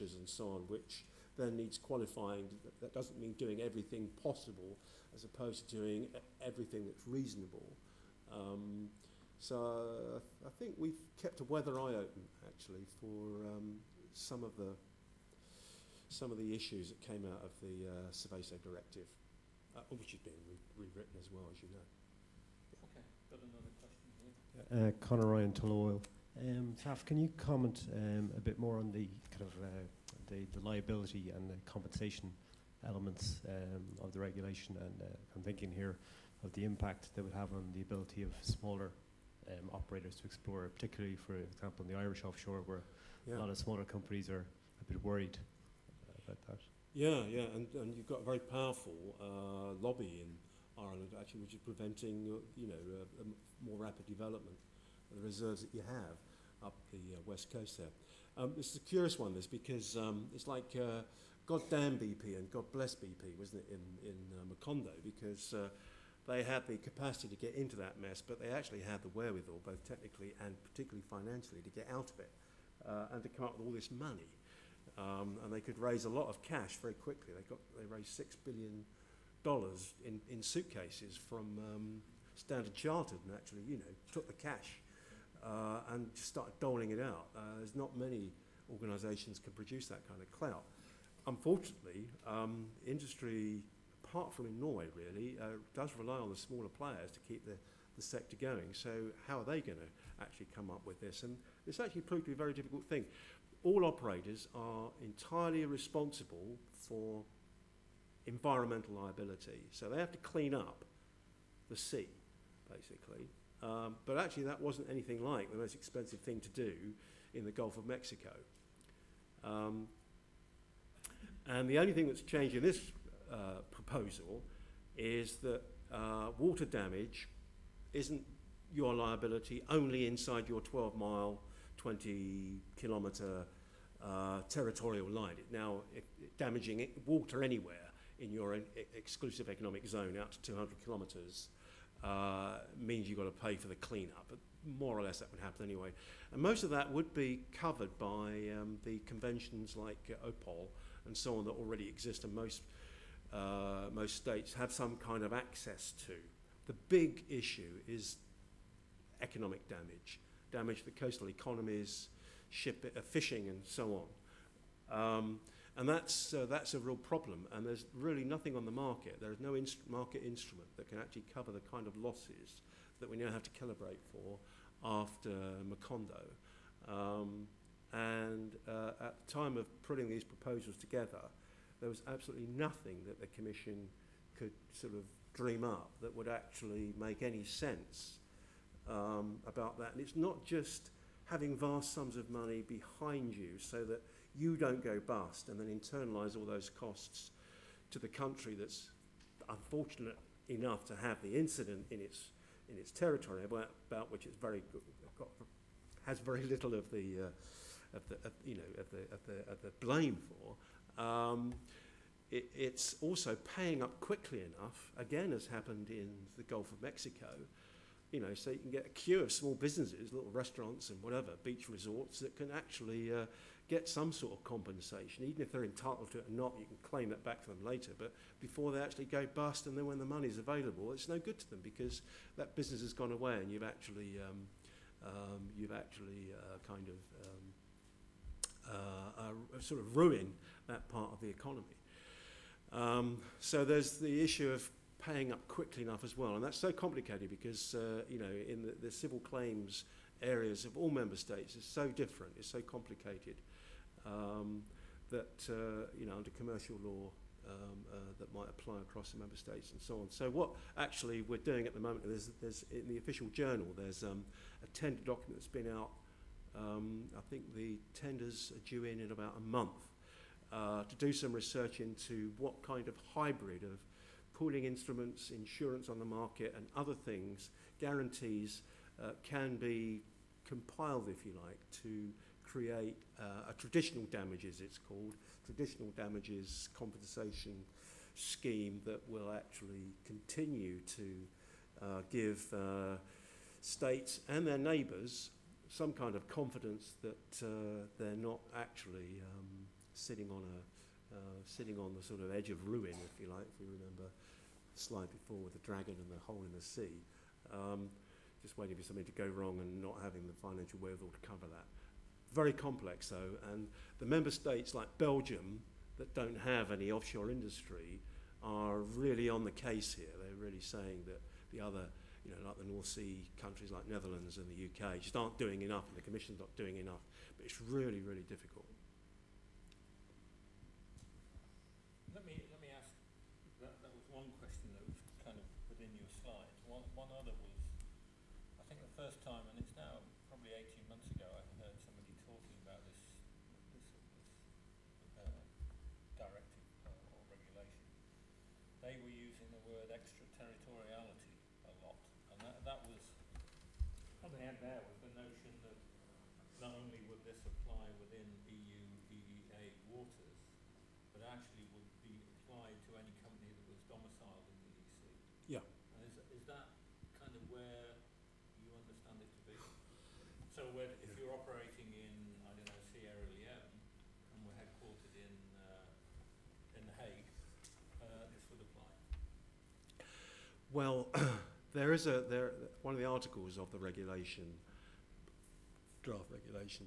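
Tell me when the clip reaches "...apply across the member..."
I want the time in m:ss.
4:18.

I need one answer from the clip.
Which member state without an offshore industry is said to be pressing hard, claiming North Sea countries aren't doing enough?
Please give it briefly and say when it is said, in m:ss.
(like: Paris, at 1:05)
Belgium, at 5:14.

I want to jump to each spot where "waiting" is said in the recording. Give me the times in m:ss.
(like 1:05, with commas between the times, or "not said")
5:08.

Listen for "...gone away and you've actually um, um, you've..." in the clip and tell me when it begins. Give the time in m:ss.
3:52.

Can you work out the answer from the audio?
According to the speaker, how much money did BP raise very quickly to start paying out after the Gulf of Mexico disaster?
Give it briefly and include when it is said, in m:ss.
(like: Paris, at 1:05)
$6 billion, at 1:18.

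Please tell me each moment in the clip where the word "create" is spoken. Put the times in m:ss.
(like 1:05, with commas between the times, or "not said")
4:42.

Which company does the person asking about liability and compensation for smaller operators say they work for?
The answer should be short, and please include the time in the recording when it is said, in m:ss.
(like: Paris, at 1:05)
Tullow Oil, at 0:25.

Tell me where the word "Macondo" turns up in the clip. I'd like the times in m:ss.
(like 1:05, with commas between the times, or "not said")
1:04, 2:55.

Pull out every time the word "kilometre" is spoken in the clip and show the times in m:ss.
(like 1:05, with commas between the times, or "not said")
2:12, 2:20.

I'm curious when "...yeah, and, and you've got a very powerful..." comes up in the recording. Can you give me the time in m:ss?
0:47.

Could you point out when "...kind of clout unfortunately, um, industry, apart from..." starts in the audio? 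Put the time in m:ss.
1:30.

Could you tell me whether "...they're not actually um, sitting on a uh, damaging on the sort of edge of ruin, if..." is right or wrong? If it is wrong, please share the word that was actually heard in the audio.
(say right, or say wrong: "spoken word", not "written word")
wrong: "sitting", not "damaging".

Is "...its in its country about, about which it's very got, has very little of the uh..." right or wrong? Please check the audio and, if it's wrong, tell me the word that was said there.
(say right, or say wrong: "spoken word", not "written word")
wrong: "territory", not "country".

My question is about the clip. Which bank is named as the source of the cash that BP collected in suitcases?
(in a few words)
Standard Chartered.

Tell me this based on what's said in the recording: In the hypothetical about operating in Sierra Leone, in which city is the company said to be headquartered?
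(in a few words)
The Hague.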